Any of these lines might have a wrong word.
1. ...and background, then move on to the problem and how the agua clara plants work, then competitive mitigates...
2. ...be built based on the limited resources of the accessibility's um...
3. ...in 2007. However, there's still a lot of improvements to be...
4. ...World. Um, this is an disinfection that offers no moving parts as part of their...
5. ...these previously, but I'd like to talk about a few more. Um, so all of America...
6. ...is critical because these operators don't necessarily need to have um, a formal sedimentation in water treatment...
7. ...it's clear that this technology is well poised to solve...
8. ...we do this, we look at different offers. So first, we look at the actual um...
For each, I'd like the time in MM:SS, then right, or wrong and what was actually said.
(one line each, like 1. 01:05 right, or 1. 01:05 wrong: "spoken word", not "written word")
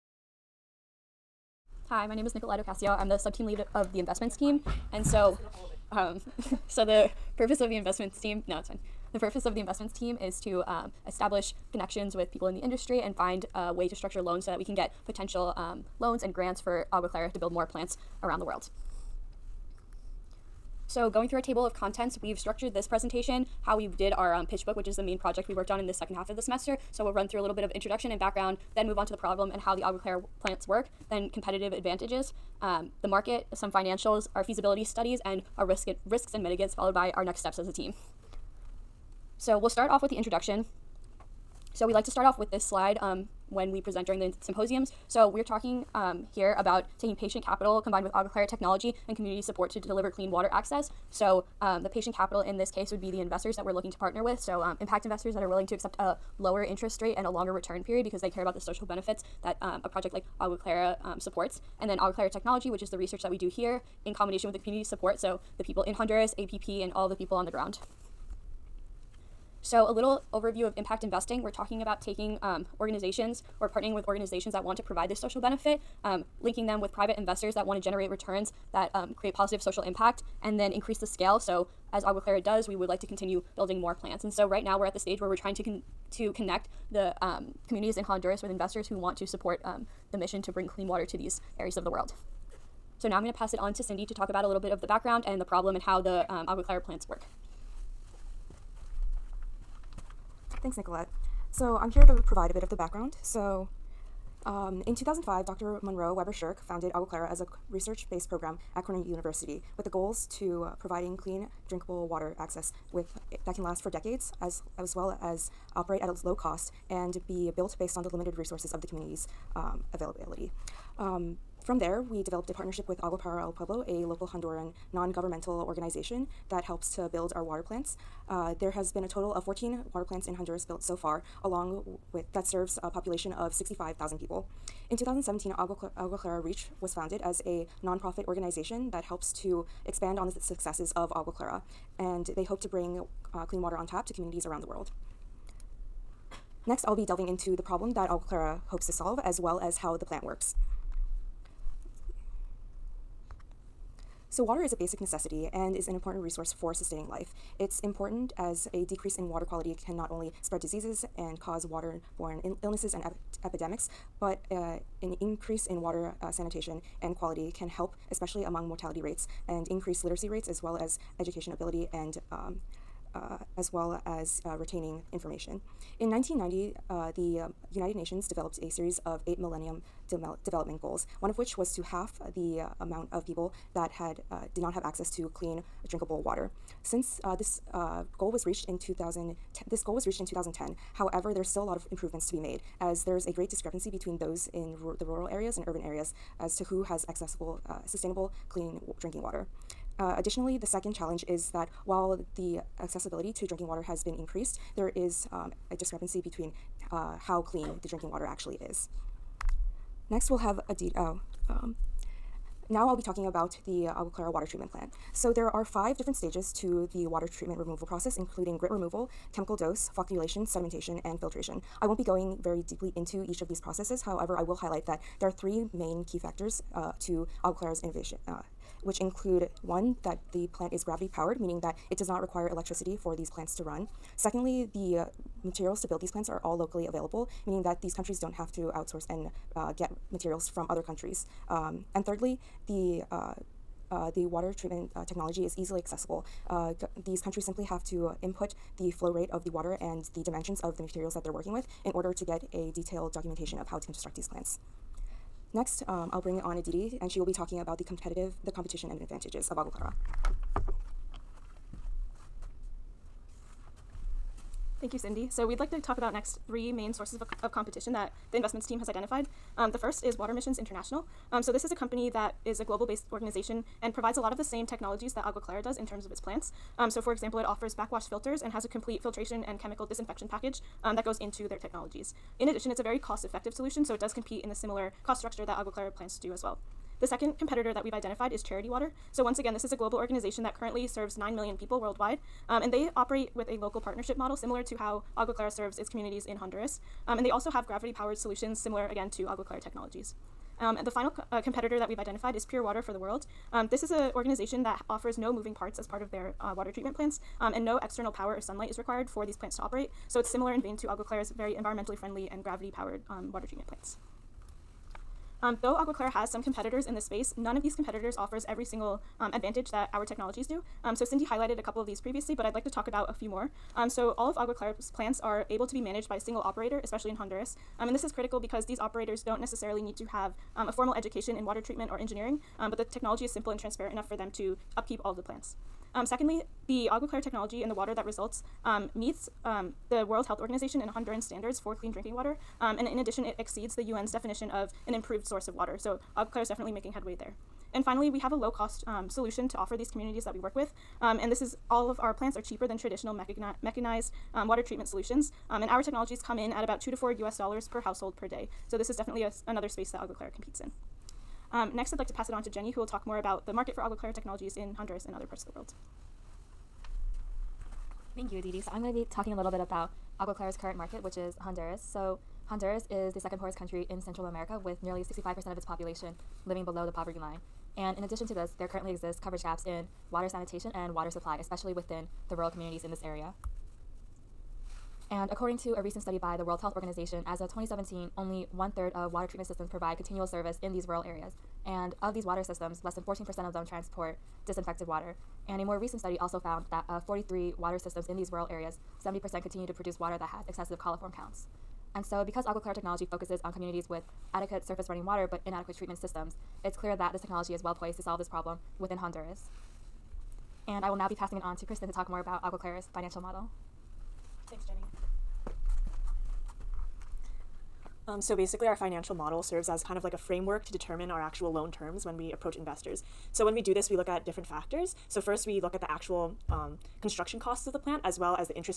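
1. 00:28 wrong: "advantages", not "mitigates"
2. 01:57 wrong: "community", not "accessibility"
3. 03:10 wrong: "2010", not "2007"
4. 05:02 wrong: "organization", not "disinfection"
5. 05:21 wrong: "Agua", not "America"
6. 05:28 wrong: "education", not "sedimentation"
7. 06:46 right
8. 07:03 wrong: "factors", not "offers".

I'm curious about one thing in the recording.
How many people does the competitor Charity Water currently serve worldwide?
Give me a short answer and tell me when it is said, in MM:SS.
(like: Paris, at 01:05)
9 million, at 04:51.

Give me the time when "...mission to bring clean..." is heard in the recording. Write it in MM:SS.
01:30.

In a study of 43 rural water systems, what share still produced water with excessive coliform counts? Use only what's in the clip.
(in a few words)
70%.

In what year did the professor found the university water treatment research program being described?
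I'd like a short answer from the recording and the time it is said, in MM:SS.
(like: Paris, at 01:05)
2005, at 01:44.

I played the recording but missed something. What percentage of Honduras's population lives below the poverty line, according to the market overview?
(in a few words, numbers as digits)
65%.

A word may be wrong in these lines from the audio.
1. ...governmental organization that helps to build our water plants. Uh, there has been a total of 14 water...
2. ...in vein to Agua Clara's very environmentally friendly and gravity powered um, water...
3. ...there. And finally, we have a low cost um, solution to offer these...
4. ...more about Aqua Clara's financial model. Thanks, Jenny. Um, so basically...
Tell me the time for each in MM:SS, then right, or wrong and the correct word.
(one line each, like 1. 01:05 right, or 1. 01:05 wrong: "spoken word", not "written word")
1. 02:05 right
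2. 05:10 right
3. 05:47 right
4. 06:52 right.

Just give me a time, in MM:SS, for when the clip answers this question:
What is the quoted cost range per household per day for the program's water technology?
05:56.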